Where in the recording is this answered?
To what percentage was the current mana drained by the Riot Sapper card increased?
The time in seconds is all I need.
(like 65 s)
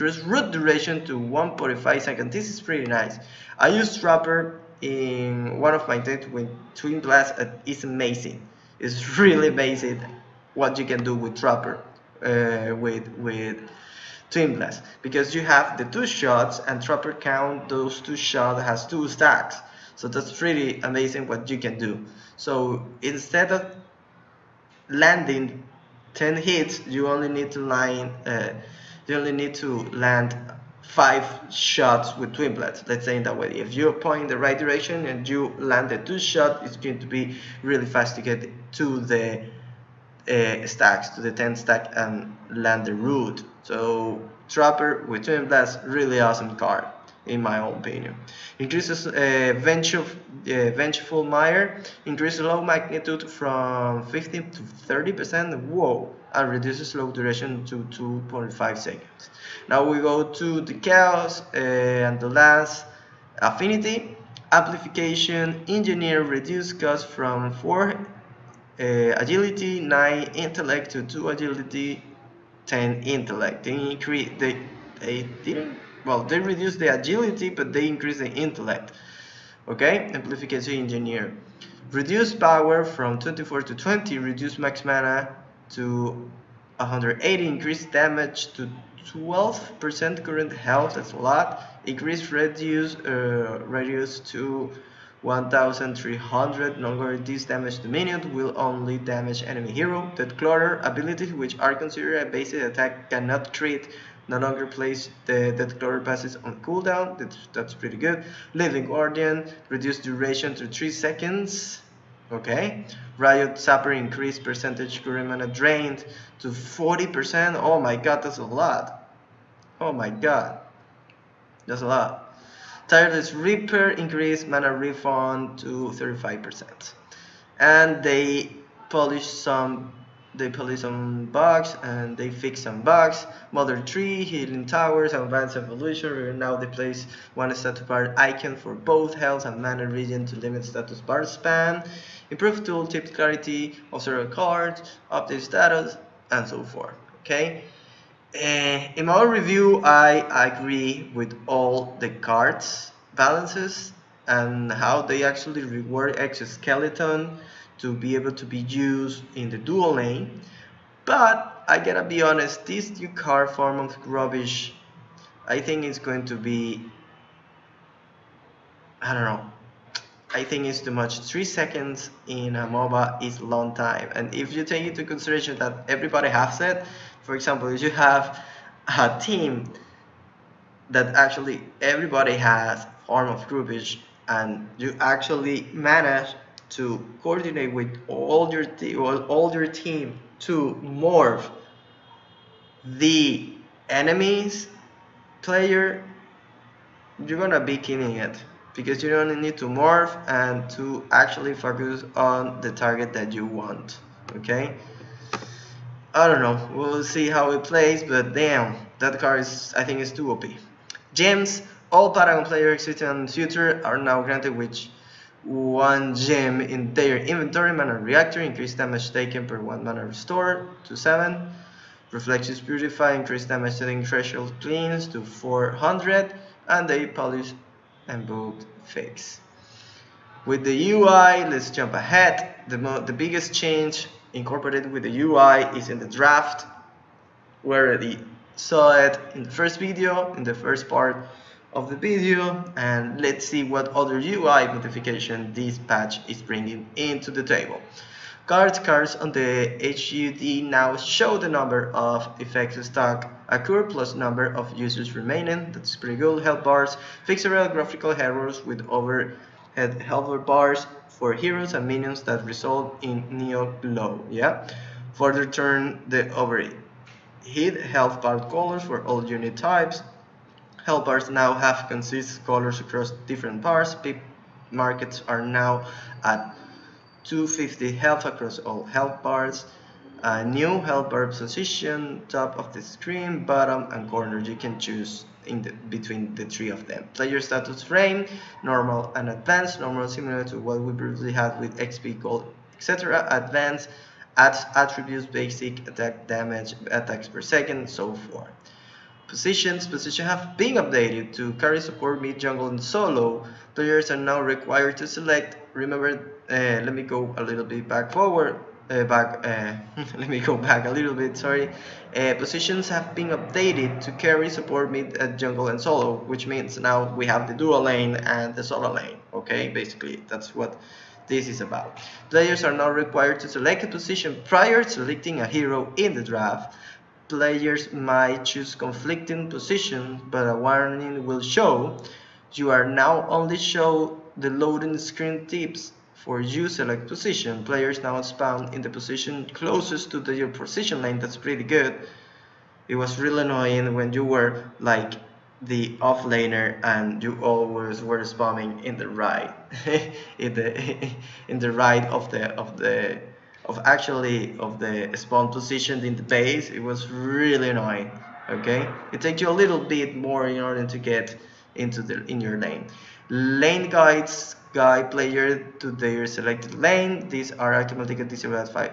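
116 s.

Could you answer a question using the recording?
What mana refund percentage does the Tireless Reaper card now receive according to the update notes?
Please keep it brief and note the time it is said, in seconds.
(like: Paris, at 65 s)
35%, at 125 s.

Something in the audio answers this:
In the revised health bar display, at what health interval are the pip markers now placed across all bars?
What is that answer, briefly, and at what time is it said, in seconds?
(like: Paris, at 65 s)
250 health, at 277 s.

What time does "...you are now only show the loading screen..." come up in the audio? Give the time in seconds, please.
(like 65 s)
332 s.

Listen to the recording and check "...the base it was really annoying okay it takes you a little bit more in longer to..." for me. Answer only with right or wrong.
wrong.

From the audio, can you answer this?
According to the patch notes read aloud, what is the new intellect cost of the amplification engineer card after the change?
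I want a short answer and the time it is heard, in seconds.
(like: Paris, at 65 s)
10 intellect, at 72 s.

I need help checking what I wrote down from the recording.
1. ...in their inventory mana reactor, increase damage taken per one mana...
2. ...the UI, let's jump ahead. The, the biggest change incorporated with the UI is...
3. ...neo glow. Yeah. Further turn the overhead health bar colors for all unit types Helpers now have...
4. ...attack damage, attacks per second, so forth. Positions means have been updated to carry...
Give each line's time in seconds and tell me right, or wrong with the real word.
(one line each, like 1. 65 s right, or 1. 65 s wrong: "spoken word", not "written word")
1. 216 s right
2. 230 s right
3. 263 s right
4. 295 s wrong: "positions", not "means".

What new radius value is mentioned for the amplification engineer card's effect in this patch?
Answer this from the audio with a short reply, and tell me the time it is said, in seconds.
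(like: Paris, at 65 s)
1300, at 95 s.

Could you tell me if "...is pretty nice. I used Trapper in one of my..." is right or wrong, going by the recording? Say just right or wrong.
right.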